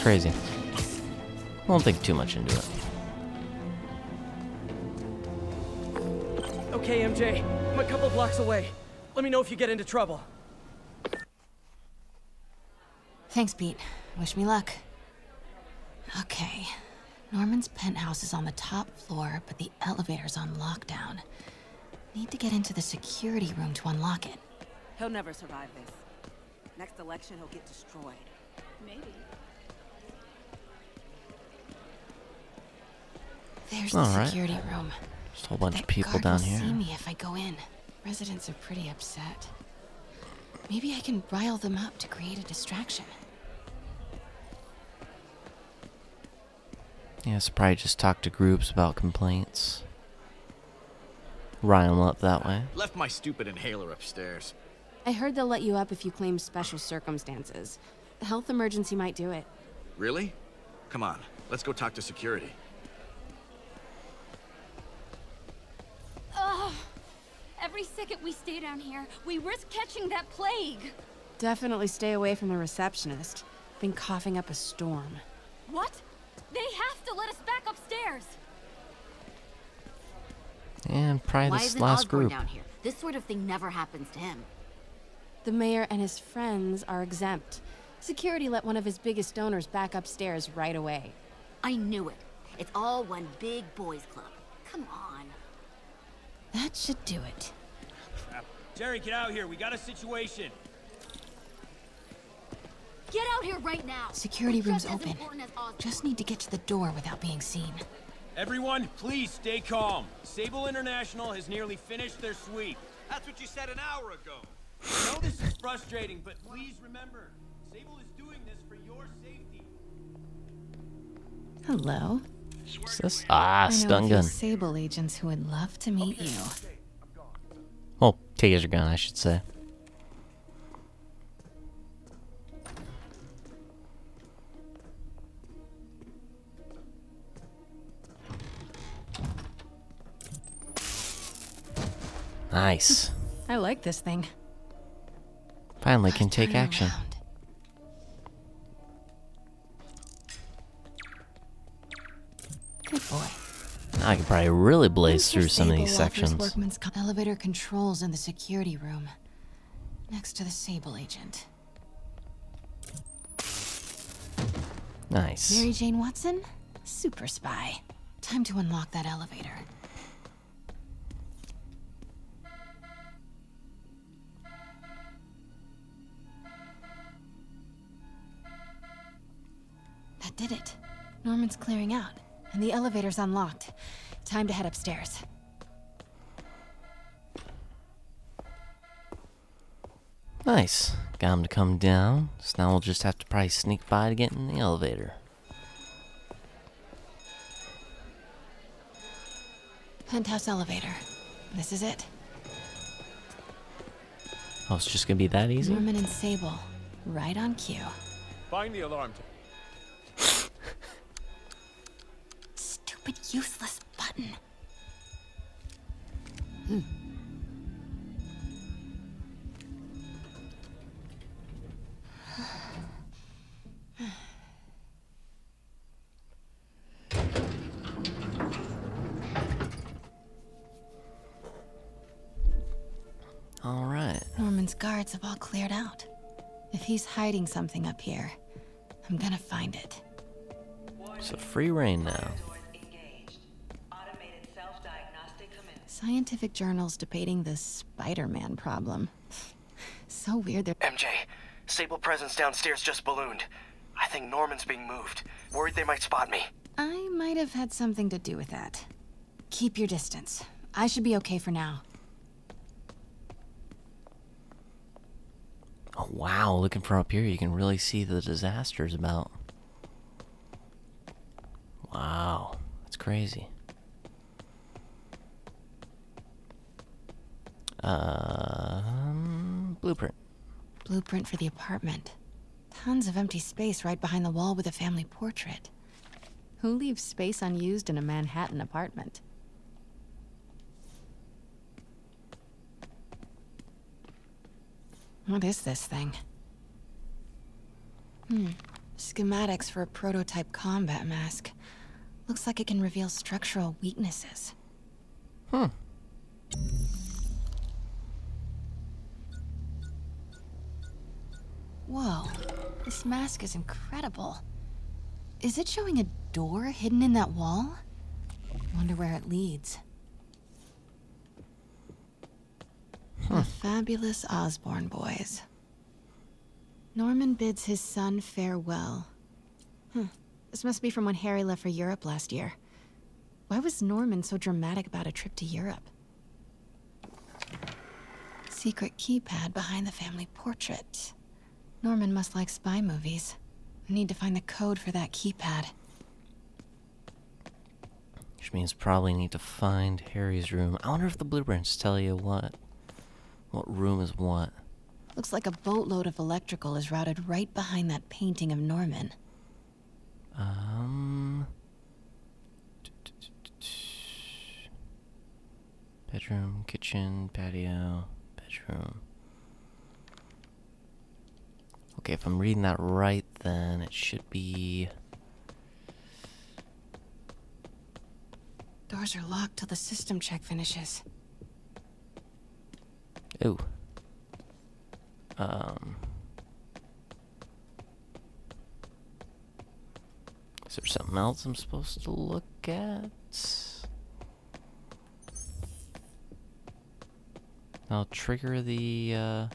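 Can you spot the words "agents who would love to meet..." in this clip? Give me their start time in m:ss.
2:04.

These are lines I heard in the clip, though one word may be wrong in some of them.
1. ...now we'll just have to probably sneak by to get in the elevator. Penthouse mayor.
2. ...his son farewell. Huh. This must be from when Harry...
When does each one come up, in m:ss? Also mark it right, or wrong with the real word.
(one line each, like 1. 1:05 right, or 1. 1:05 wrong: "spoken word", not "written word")
1. 3:12 wrong: "elevator", not "mayor"
2. 5:27 right.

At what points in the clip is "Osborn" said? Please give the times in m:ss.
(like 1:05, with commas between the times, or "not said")
1:22, 5:24.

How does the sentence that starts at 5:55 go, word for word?
Looks like a boatload of electrical is routed right behind that painting of Norman.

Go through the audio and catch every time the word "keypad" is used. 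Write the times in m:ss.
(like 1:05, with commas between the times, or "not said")
5:38, 5:45.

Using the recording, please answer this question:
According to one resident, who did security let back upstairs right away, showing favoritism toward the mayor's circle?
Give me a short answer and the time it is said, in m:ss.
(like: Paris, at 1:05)
One of his biggest donors, at 1:28.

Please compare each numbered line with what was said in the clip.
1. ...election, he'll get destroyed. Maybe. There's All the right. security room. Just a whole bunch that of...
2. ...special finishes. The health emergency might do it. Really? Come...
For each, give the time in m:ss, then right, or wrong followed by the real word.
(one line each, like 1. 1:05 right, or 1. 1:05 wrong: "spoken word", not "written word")
1. 0:26 right
2. 0:56 wrong: "circumstances", not "finishes".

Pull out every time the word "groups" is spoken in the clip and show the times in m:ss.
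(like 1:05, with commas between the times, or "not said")
0:48, 1:22.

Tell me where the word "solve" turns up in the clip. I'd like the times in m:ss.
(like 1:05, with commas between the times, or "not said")
not said.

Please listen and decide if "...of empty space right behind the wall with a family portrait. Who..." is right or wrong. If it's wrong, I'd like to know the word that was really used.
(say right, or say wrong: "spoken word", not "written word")
right.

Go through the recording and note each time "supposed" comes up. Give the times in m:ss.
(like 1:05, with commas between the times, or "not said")
6:31.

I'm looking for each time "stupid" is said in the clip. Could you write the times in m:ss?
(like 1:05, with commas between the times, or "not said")
0:53, 3:32.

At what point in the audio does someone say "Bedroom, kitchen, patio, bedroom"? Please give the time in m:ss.
6:06.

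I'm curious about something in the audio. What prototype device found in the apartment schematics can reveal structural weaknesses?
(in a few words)
Combat mask.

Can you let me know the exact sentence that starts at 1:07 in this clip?
Every second we stay down here, we risk catching that plague.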